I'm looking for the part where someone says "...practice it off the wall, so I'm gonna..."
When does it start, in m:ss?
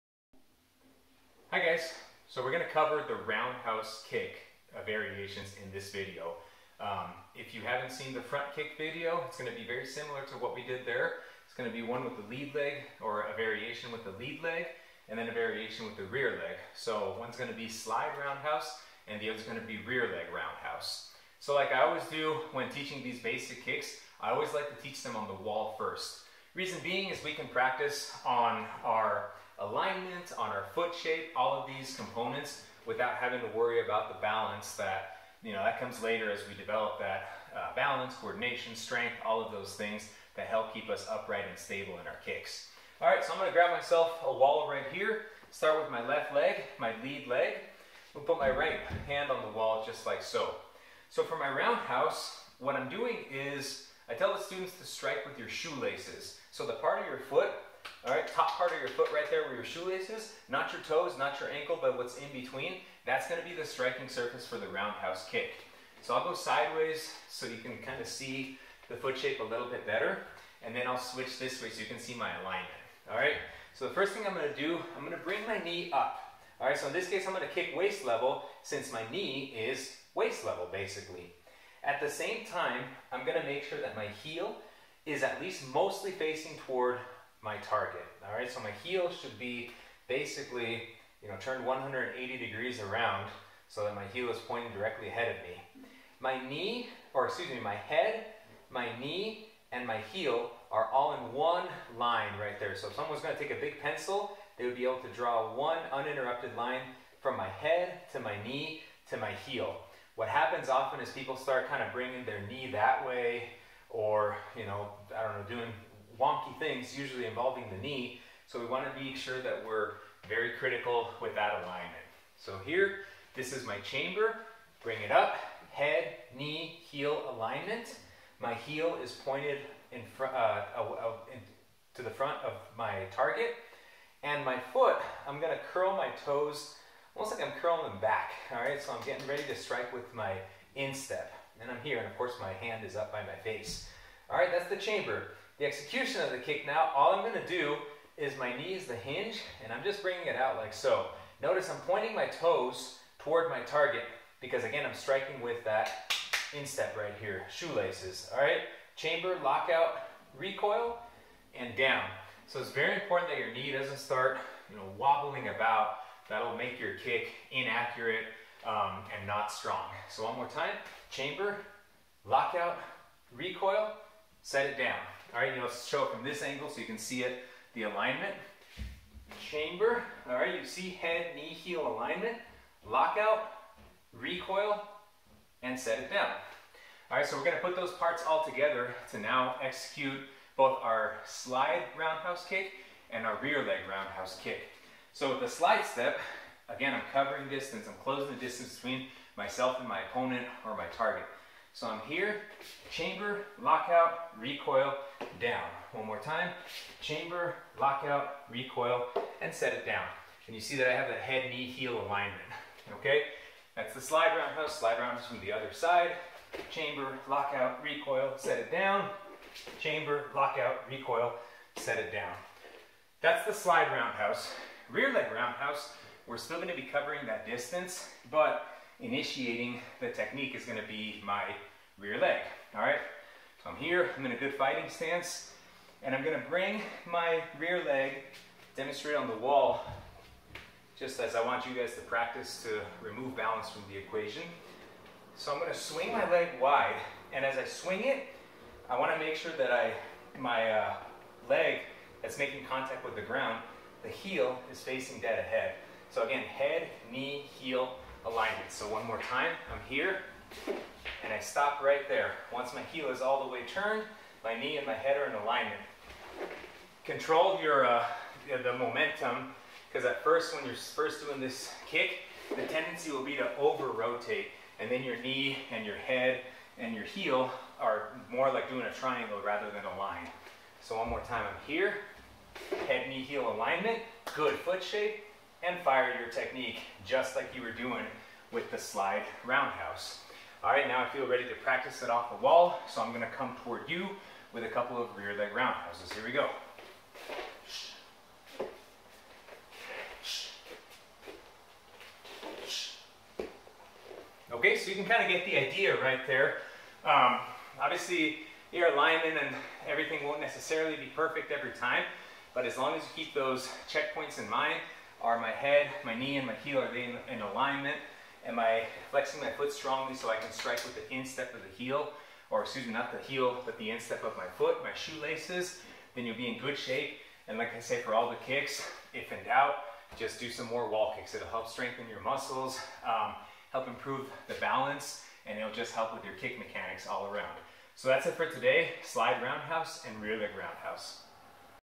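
4:51.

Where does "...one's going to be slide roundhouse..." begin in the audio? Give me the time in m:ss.
0:17.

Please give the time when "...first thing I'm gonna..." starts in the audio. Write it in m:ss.
1:13.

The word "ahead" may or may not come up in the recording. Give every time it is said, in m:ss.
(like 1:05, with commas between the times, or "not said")
1:35, 4:15.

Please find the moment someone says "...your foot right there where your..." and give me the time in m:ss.
0:58.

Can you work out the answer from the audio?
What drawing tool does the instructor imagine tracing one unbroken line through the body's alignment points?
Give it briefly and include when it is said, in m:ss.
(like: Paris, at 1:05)
a big pencil, at 1:43.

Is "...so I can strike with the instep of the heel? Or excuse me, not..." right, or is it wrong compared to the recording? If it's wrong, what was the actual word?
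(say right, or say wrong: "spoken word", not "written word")
right.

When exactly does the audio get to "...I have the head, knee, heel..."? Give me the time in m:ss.
3:30.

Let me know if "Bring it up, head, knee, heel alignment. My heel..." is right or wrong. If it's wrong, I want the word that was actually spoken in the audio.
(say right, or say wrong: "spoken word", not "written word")
right.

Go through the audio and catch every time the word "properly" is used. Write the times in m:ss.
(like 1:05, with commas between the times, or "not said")
not said.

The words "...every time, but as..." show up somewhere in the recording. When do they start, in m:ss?
5:11.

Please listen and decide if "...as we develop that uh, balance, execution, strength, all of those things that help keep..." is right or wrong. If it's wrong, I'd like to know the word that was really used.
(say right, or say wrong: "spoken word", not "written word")
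wrong: "coordination", not "execution".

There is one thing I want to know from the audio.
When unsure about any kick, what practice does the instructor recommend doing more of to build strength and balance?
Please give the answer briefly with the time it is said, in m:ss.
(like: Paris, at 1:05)
wall kicks, at 5:30.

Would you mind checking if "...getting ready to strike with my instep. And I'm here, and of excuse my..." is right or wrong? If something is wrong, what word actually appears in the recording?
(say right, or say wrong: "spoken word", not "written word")
wrong: "course", not "excuse".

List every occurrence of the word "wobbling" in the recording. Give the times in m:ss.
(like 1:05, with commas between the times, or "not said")
2:44.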